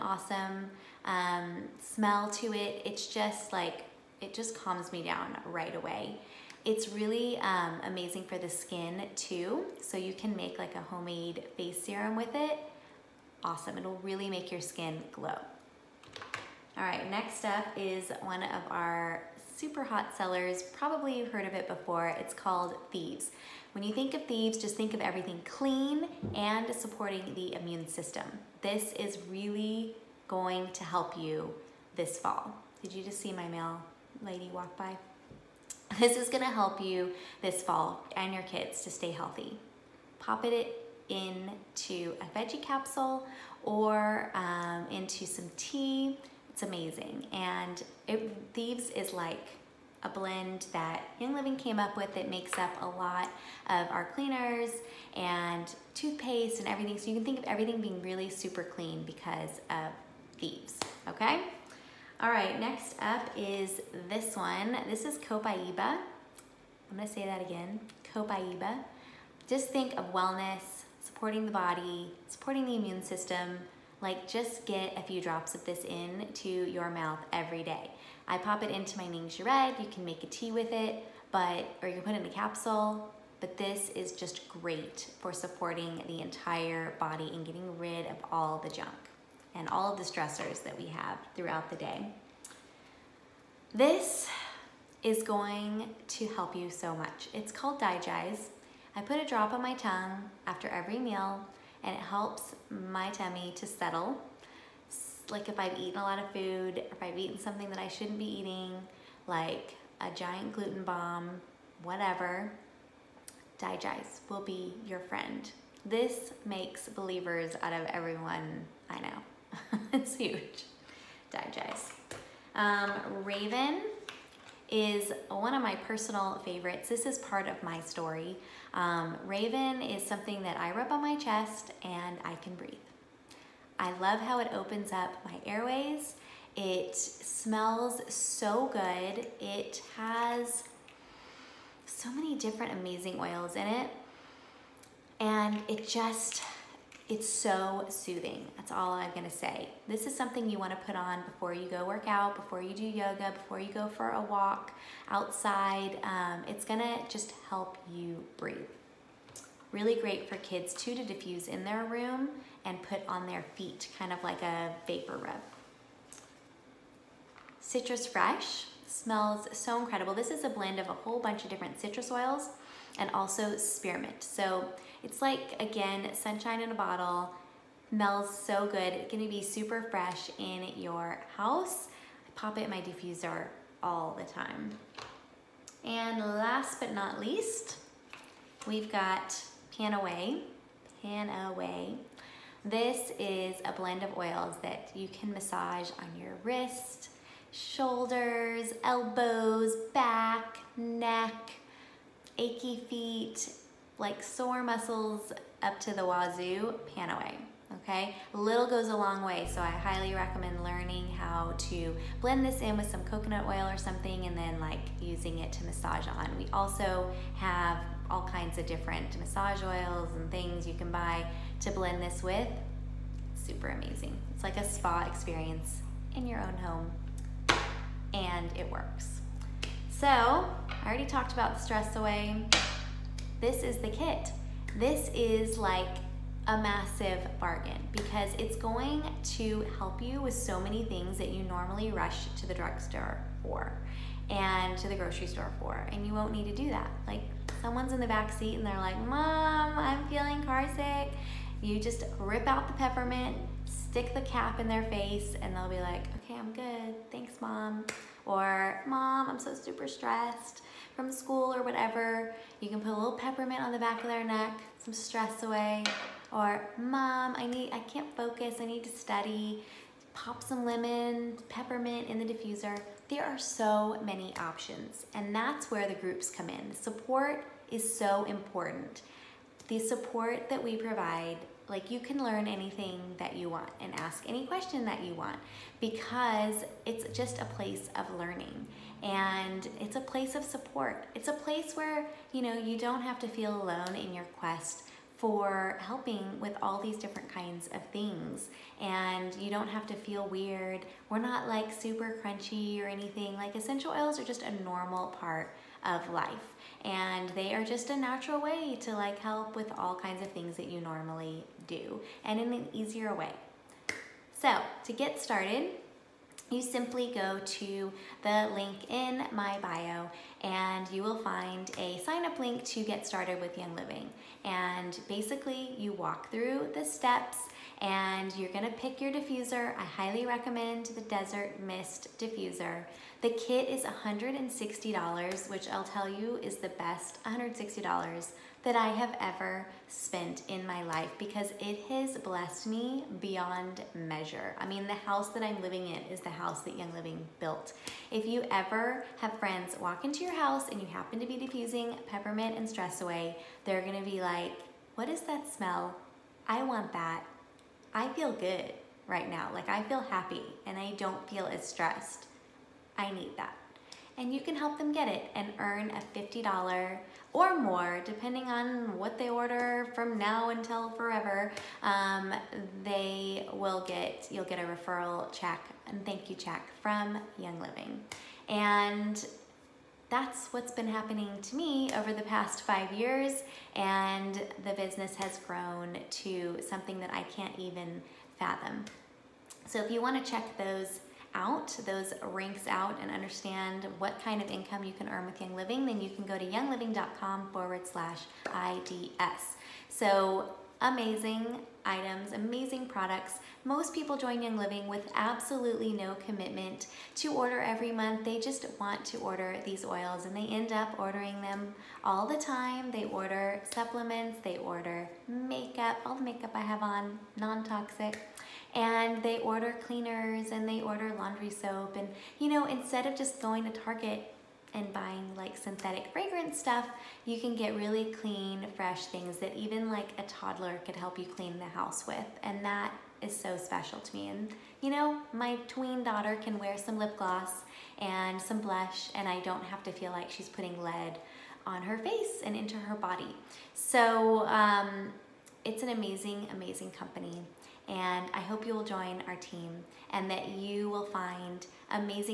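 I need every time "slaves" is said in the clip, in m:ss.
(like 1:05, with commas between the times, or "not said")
not said.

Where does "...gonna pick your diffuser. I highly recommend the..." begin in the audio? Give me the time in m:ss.
5:28.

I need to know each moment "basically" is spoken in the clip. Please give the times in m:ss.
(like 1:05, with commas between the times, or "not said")
5:25.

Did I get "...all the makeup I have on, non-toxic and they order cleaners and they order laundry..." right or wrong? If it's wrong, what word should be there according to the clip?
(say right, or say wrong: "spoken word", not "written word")
right.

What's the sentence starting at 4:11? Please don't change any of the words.
You just rip out the peppermint, stick the cap in their face and they'll be like, okay, I'm good.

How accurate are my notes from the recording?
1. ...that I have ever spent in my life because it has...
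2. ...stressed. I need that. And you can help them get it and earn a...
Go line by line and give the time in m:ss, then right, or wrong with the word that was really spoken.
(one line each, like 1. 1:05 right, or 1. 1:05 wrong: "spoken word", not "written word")
1. 5:38 right
2. 6:01 right.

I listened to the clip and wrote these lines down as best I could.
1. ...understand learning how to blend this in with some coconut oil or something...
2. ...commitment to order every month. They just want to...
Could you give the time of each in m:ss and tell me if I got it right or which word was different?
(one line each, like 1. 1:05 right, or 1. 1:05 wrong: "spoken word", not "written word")
1. 3:30 wrong: "recommend", not "understand"
2. 6:46 right.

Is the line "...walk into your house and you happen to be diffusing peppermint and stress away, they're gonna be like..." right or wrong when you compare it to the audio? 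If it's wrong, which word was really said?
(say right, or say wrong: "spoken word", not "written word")
right.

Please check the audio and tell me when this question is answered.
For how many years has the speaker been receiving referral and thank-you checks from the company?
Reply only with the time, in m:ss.
6:22.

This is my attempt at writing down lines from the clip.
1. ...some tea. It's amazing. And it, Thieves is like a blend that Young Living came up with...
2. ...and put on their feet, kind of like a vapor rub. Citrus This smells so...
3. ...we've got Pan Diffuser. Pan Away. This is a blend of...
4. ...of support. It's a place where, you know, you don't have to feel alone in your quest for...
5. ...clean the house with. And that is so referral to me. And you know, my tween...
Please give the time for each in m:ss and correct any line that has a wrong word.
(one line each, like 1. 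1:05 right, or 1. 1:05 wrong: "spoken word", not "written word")
1. 0:45 right
2. 2:42 wrong: "Fresh", not "This"
3. 3:08 wrong: "Away", not "Diffuser"
4. 4:50 right
5. 7:11 wrong: "special", not "referral".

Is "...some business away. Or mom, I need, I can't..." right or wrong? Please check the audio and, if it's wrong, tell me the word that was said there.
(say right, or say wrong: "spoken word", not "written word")
wrong: "stress", not "business".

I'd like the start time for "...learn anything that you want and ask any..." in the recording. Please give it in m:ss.
4:42.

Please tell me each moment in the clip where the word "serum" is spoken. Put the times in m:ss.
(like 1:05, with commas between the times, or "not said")
0:11.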